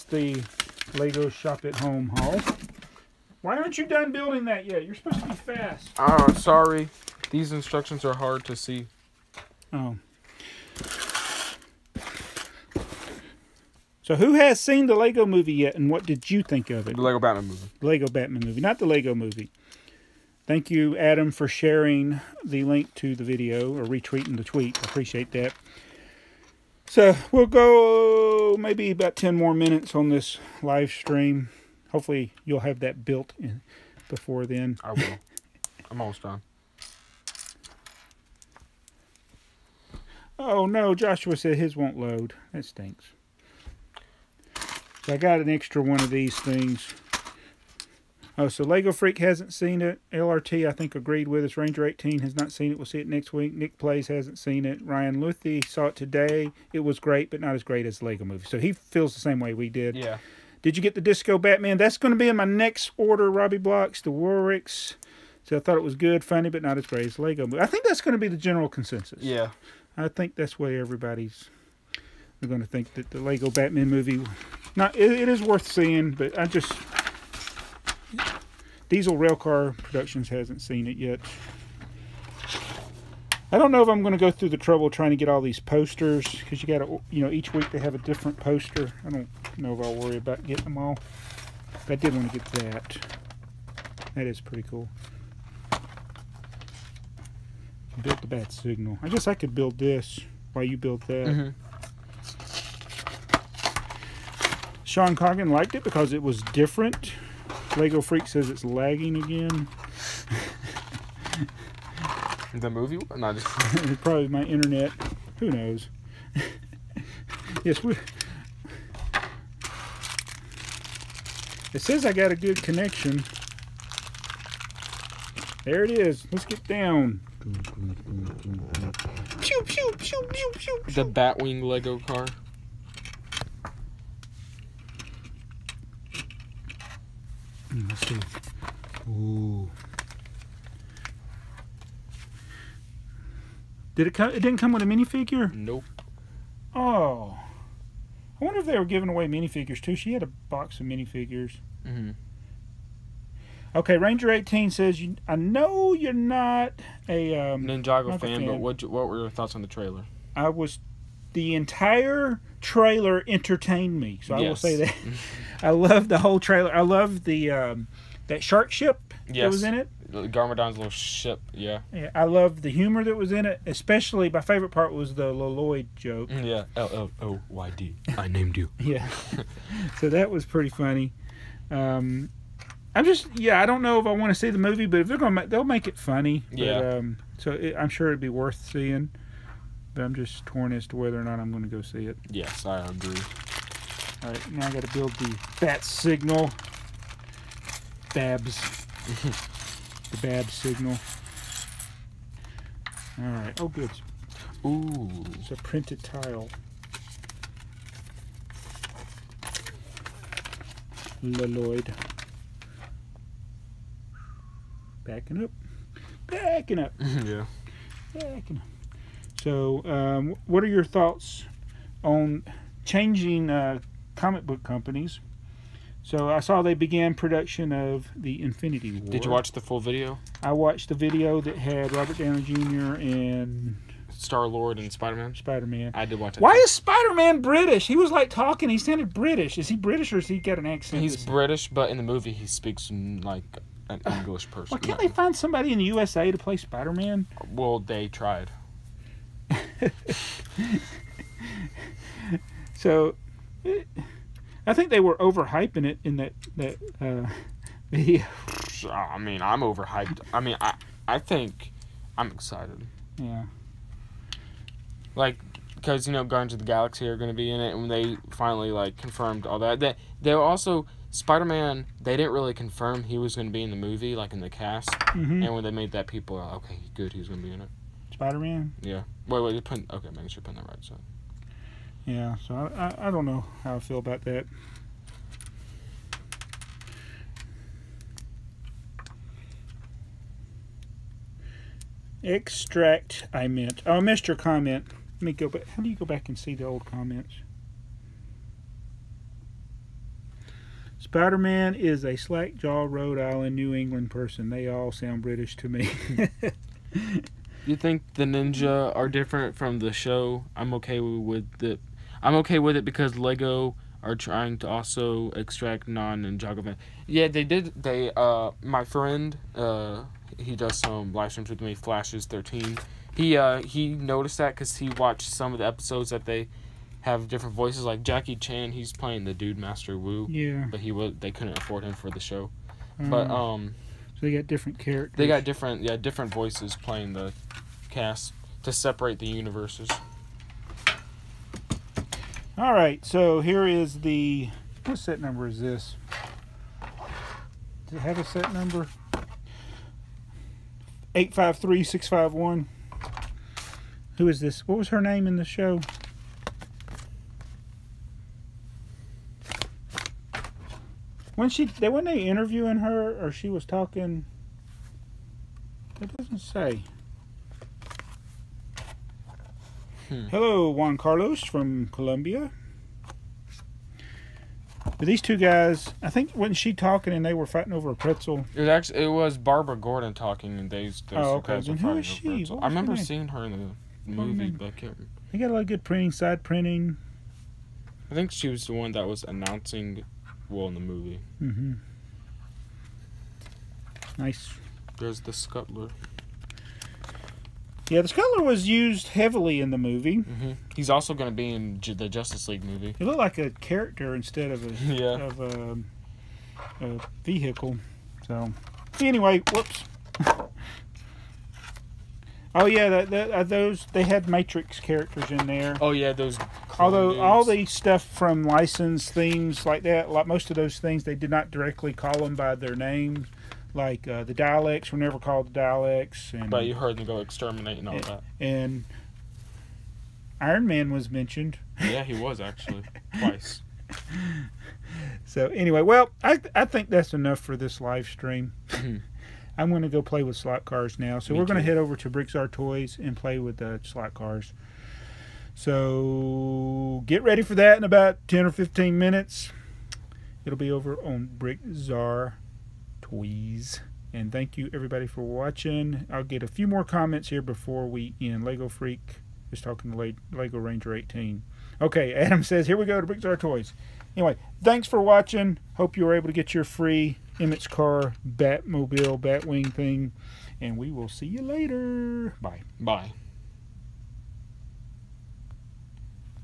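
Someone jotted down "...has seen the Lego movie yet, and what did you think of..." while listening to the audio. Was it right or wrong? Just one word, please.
right.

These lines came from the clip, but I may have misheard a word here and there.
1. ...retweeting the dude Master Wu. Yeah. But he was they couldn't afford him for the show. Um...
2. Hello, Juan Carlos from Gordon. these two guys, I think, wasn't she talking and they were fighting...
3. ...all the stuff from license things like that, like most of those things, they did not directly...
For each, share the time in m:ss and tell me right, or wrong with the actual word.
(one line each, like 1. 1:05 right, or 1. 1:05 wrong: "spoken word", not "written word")
1. 5:28 wrong: "playing", not "retweeting"
2. 6:10 wrong: "Colombia", not "Gordon"
3. 6:57 right.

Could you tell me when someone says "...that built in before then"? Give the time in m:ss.
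0:32.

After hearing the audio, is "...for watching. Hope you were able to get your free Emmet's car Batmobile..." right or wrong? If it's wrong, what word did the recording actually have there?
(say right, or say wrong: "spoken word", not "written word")
right.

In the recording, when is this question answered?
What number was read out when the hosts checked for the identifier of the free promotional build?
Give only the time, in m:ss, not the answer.
5:51.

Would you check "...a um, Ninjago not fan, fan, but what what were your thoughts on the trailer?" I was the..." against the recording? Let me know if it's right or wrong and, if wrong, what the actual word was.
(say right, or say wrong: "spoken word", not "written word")
right.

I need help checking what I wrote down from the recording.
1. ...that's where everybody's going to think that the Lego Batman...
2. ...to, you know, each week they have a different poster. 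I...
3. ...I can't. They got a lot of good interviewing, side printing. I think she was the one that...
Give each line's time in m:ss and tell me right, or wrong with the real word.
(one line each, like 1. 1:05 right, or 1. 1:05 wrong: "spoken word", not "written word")
1. 1:10 right
2. 1:26 right
3. 6:24 wrong: "printing", not "interviewing".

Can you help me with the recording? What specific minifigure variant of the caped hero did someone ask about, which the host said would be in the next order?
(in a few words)
Disco Batman.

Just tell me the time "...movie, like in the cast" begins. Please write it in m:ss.
4:33.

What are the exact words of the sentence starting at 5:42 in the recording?
All right, so here is the, what set number is this?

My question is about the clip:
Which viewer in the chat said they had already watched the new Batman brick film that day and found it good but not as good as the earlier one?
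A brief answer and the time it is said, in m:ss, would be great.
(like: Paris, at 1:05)
Ryan Luthy, at 0:54.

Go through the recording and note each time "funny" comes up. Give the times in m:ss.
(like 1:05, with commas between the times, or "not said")
1:06, 3:00, 3:05.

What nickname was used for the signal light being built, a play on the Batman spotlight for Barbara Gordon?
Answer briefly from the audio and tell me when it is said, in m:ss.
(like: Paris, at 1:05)
Babs signal, at 3:20.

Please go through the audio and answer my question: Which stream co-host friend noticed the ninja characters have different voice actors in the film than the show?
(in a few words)
Flashes thirteen.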